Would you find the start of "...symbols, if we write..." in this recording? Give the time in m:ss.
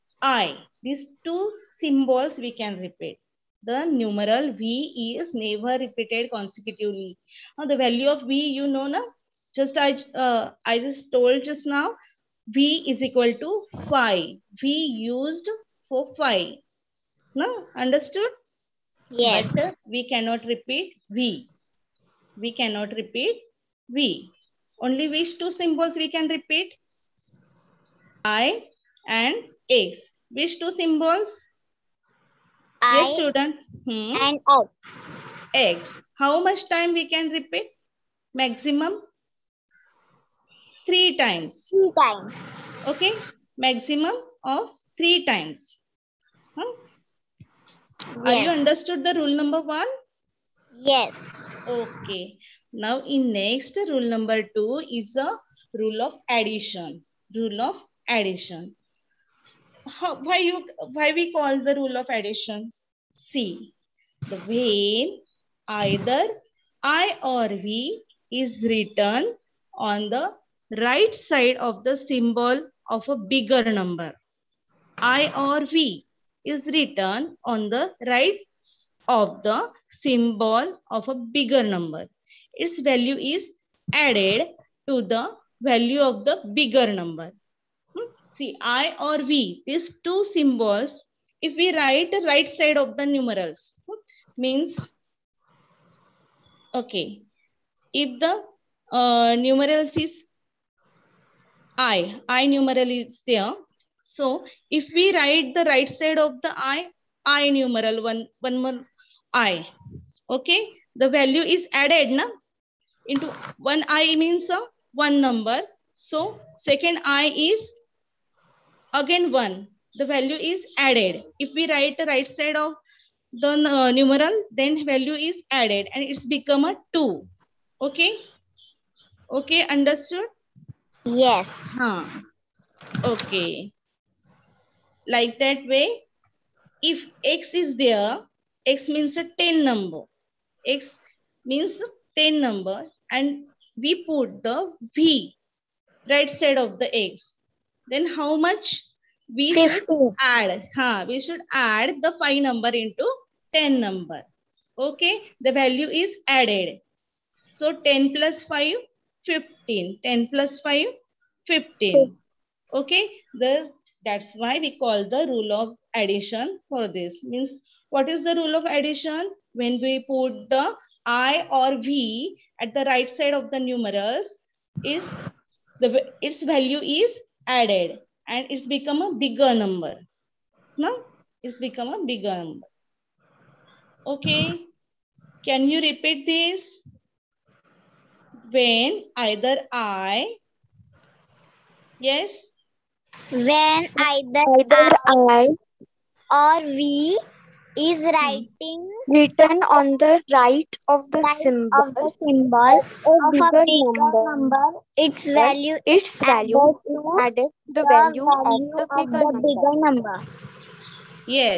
1:30.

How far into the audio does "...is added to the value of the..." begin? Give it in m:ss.
1:23.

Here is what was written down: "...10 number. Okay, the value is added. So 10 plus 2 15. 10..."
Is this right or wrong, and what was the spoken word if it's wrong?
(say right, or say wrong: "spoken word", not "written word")
wrong: "5", not "2".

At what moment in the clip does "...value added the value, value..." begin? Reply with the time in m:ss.
3:26.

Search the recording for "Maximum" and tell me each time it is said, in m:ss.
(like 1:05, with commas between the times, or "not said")
0:38, 0:43.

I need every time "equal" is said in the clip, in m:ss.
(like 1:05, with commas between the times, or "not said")
0:13.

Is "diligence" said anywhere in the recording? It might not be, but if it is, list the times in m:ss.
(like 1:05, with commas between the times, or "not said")
not said.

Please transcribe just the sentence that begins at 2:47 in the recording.
Means what is the rule of addition?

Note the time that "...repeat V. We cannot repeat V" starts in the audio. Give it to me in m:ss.
0:20.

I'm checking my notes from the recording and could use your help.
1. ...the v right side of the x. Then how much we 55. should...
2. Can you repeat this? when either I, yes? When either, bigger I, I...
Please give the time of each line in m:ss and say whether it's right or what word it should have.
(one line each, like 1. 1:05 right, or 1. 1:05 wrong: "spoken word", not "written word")
1. 2:24 wrong: "50", not "55"
2. 3:05 wrong: "either", not "bigger".